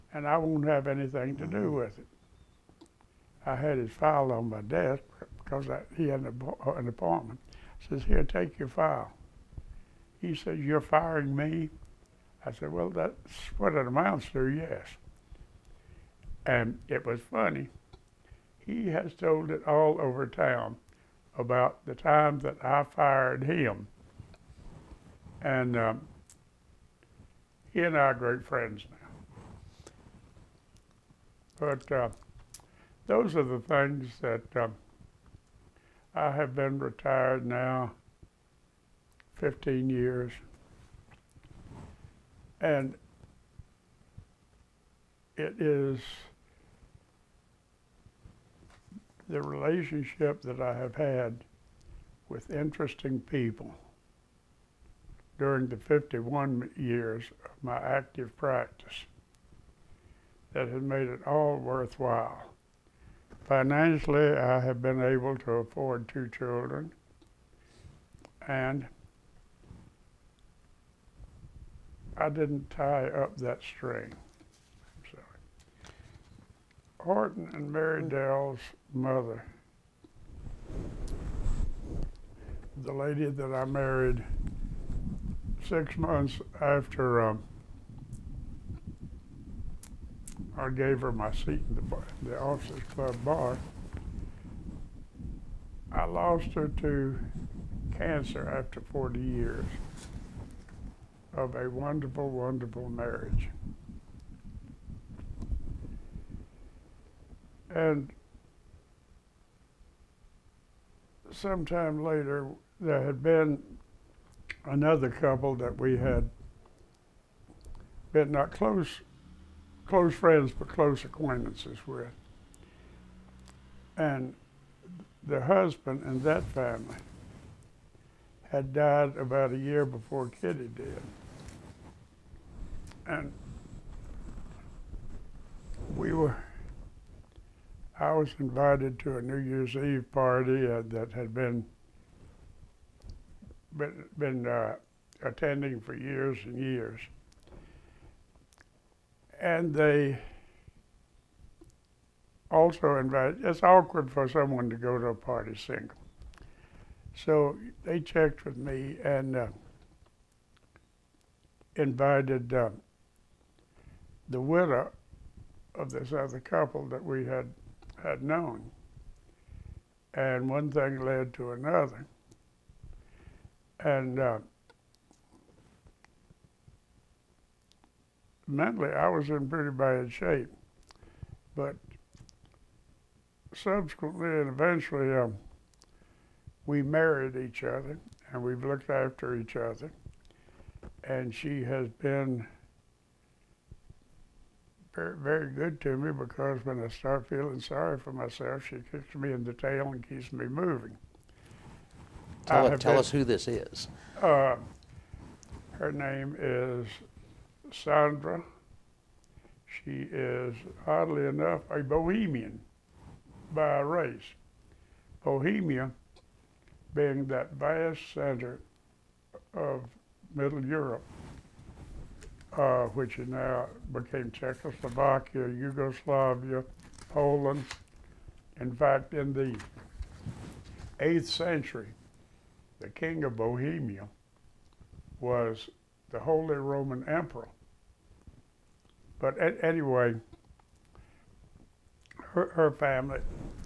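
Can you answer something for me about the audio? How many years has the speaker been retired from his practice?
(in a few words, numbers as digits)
15.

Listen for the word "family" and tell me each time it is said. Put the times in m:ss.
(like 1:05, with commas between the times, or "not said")
2:06, 4:02.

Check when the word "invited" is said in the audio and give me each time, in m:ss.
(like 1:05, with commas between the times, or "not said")
2:18, 2:32, 2:41.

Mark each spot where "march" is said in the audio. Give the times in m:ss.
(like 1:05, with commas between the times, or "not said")
not said.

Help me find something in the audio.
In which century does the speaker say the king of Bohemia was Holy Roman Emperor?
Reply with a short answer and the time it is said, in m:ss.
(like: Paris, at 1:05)
8th century, at 3:50.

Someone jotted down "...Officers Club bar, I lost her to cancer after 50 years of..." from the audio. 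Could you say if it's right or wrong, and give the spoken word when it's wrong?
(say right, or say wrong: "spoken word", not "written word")
wrong: "40", not "50".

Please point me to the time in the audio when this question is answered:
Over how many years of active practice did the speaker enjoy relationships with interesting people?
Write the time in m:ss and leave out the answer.
0:55.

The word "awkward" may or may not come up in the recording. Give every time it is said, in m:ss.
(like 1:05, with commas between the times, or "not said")
2:33.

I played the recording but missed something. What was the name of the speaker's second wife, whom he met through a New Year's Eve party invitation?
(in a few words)
Sandra.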